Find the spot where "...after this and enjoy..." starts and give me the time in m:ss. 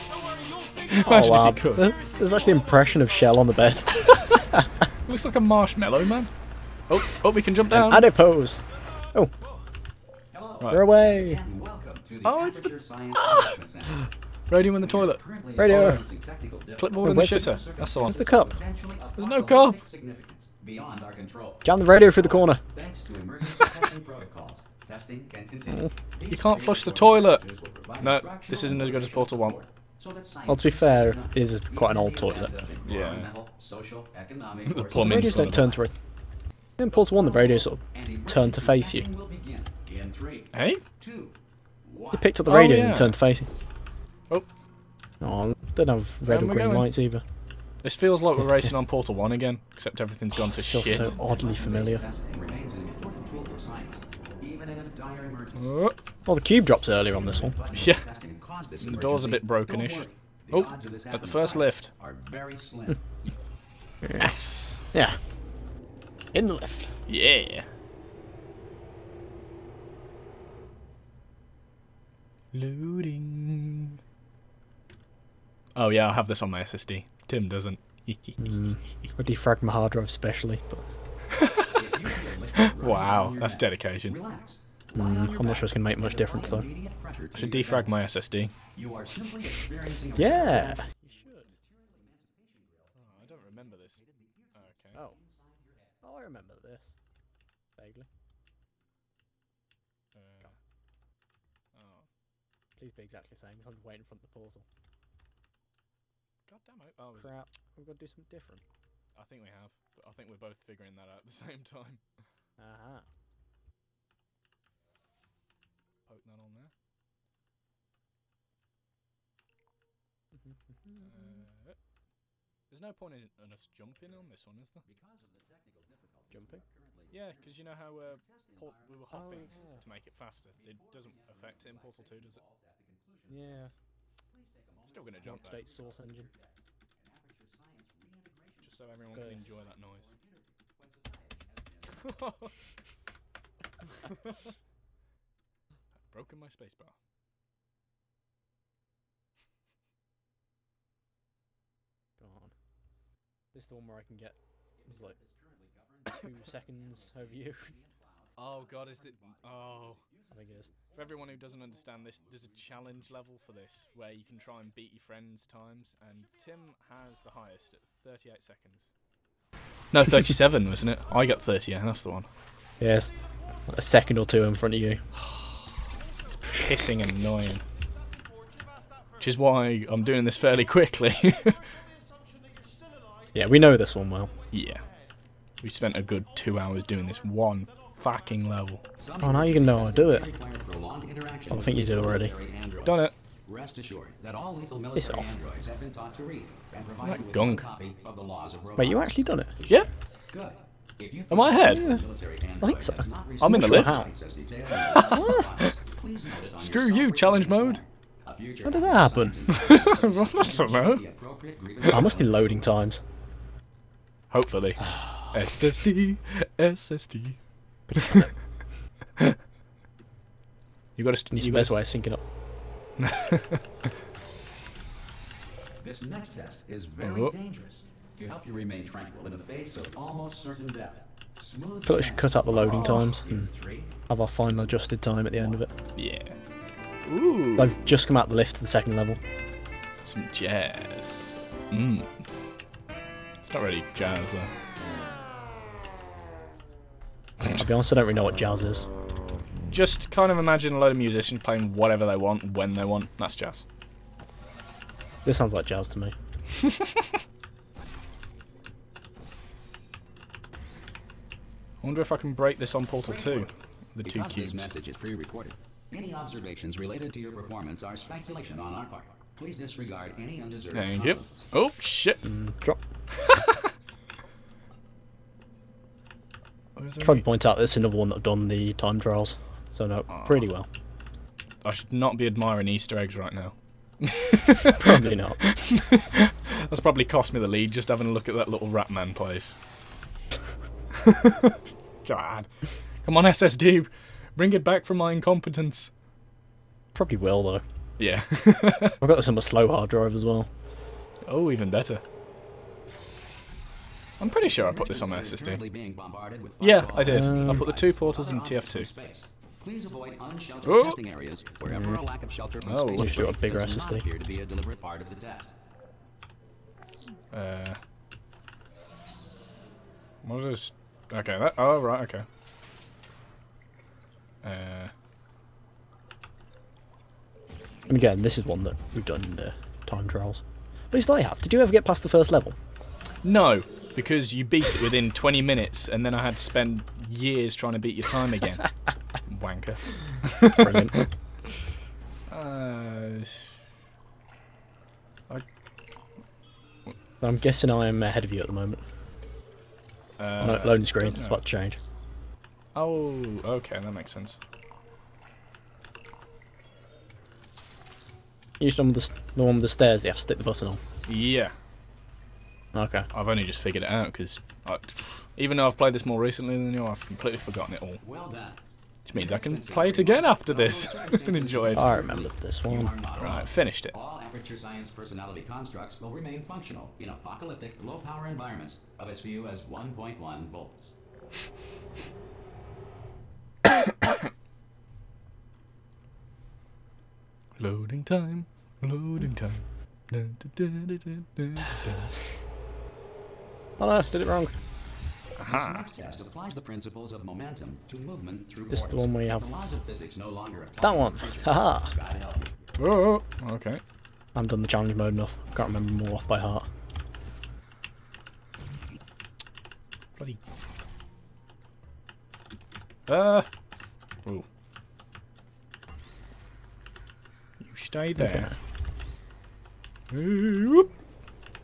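6:10.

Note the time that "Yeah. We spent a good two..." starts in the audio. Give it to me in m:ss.
3:04.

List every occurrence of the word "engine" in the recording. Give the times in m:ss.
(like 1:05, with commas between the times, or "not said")
2:15.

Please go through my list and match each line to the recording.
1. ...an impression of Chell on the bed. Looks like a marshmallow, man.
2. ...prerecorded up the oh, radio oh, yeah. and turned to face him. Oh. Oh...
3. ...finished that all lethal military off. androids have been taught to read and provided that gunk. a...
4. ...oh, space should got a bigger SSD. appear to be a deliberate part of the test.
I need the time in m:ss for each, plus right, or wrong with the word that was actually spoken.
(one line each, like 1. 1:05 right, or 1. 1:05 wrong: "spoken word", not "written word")
1. 0:02 right
2. 0:42 wrong: "picked", not "prerecorded"
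3. 3:13 wrong: "assured", not "finished"
4. 5:12 right.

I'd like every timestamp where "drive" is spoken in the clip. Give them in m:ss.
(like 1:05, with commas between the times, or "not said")
1:19, 4:59.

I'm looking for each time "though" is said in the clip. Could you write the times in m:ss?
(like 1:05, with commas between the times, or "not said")
1:26, 4:04, 4:57, 6:05.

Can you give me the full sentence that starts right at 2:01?
uh, there's no point in, in, us jumping on this one, is there?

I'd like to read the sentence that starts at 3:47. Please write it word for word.
dangerous to help you remain tranquil in the face of almost certain death.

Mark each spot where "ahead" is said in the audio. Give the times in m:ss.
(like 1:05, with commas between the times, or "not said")
3:21, 5:48.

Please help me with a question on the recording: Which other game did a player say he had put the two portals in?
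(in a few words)
TF2.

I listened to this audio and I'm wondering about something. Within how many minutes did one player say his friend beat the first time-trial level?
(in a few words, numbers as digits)
20 minutes.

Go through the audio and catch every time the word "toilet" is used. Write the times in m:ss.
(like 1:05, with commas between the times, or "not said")
0:14, 0:26, 0:32.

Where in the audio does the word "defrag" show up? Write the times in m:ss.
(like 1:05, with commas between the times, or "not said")
1:19, 1:27.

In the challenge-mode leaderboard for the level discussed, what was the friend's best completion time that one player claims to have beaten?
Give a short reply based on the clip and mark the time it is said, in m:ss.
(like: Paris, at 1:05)
38 seconds, at 2:47.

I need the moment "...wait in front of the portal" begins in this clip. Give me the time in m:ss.
1:43.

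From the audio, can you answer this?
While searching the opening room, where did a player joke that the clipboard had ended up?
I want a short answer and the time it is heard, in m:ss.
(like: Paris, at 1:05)
in the shitter, at 0:17.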